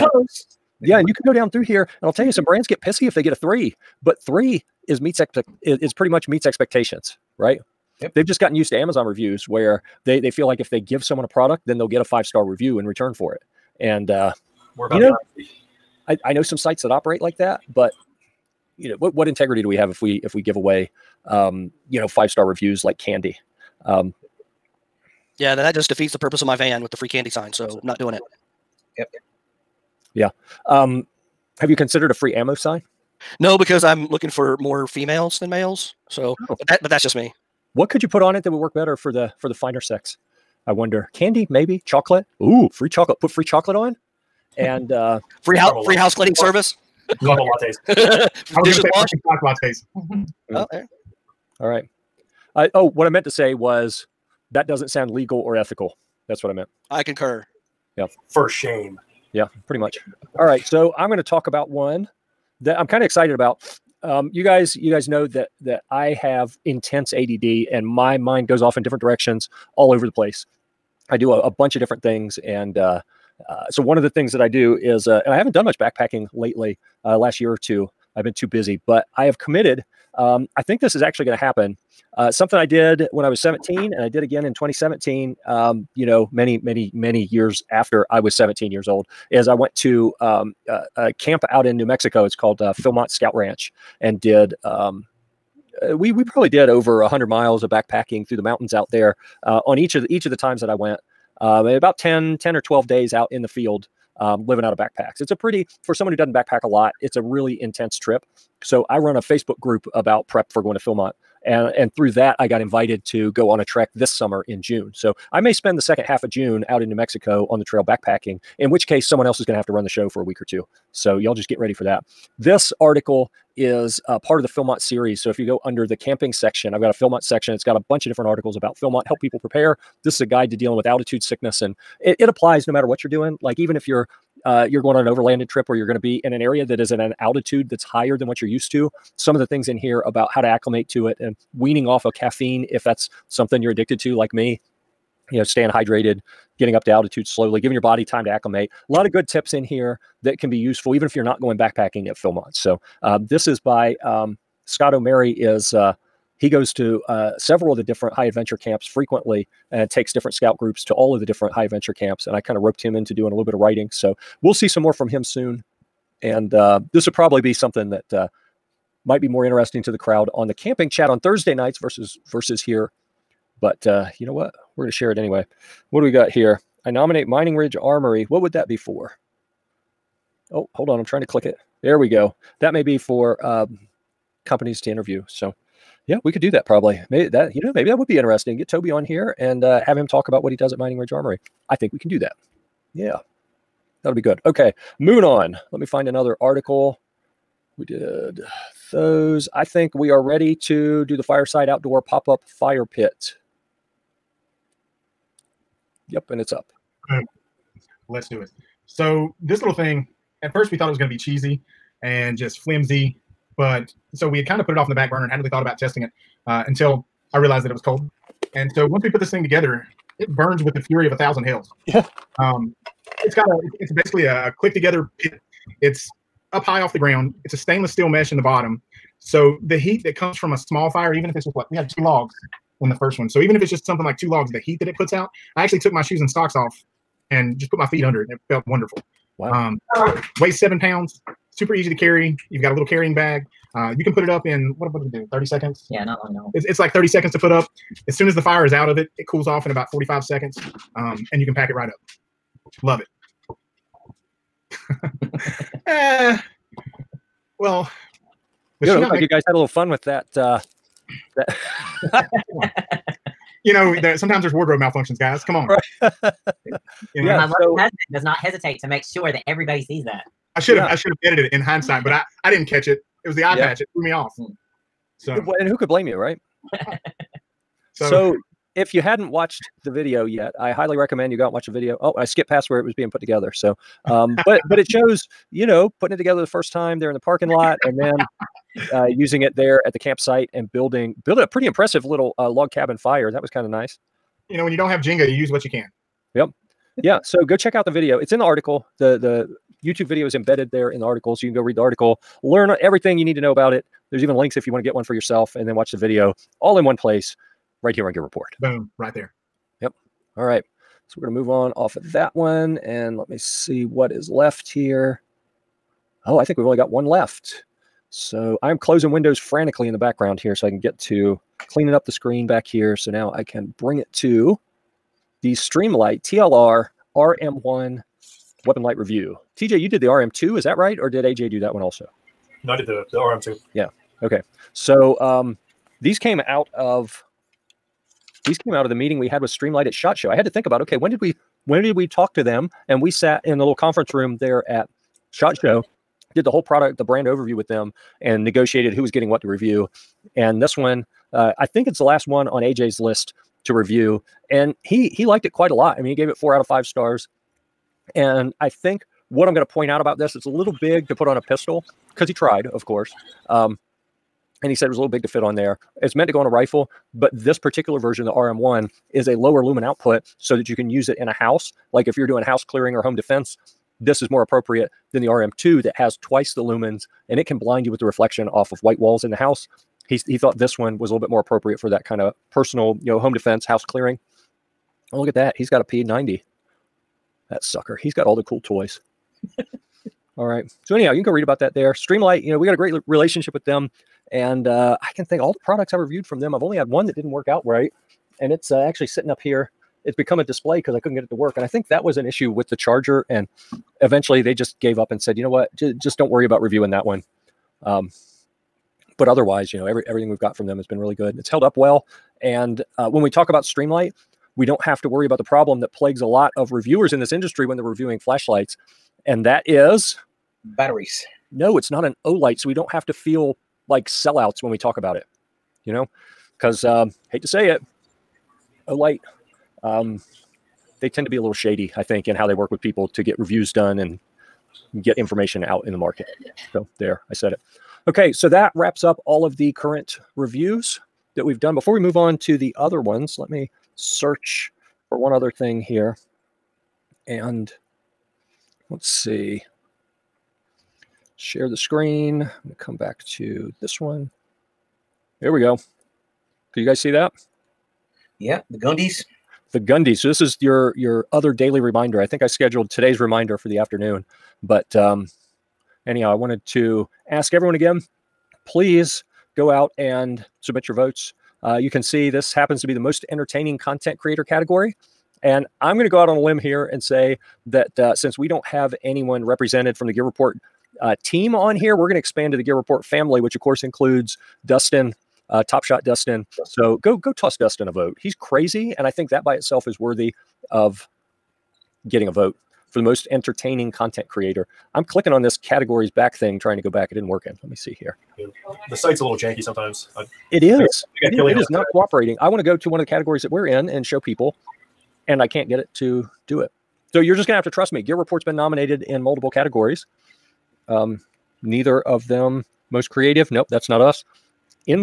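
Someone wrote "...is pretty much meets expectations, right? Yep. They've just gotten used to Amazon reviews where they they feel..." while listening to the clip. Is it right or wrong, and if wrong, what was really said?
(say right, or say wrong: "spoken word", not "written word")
right.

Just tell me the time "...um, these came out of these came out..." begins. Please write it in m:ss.
5:35.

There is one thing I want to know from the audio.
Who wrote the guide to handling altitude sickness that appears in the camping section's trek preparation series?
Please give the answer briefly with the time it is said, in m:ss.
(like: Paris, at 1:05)
Scott O'Mary, at 2:34.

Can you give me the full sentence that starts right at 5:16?
Oh, I think we've only got one left.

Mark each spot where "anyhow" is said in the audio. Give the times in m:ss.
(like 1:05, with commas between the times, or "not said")
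6:30, 7:46.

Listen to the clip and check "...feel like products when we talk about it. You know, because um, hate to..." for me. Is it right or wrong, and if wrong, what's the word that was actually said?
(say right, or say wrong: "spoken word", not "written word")
wrong: "sellouts", not "products".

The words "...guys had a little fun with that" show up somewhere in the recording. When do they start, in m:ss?
4:19.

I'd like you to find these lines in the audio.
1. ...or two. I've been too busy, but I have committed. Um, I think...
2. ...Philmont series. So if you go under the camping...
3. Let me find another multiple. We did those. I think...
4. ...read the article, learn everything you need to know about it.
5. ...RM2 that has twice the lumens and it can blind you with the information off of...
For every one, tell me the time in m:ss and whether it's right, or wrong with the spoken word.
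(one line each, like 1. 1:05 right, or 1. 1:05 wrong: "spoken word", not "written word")
1. 1:17 right
2. 2:04 right
3. 3:15 wrong: "article", not "multiple"
4. 5:01 right
5. 6:15 wrong: "reflection", not "information".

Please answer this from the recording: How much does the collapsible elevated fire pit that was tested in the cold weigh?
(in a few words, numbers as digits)
7 pounds.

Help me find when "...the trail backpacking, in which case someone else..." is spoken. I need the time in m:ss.
1:57.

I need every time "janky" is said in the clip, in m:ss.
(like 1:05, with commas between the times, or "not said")
8:19.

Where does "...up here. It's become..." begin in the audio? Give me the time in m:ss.
6:39.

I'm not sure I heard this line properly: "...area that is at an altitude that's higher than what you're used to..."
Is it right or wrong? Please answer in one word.
right.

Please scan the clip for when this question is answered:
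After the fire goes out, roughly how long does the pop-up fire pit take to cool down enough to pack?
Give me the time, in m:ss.
4:09.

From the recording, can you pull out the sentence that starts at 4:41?
Oh, I skipped past where it was being put together.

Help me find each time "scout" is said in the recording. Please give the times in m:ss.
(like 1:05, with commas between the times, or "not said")
1:33, 2:40.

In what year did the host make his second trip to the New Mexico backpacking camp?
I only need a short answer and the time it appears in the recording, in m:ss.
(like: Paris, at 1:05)
2017, at 1:24.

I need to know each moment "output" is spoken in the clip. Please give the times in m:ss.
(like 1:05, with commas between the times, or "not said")
6:09.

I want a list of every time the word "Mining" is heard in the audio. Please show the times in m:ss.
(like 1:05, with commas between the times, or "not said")
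2:57, 3:10.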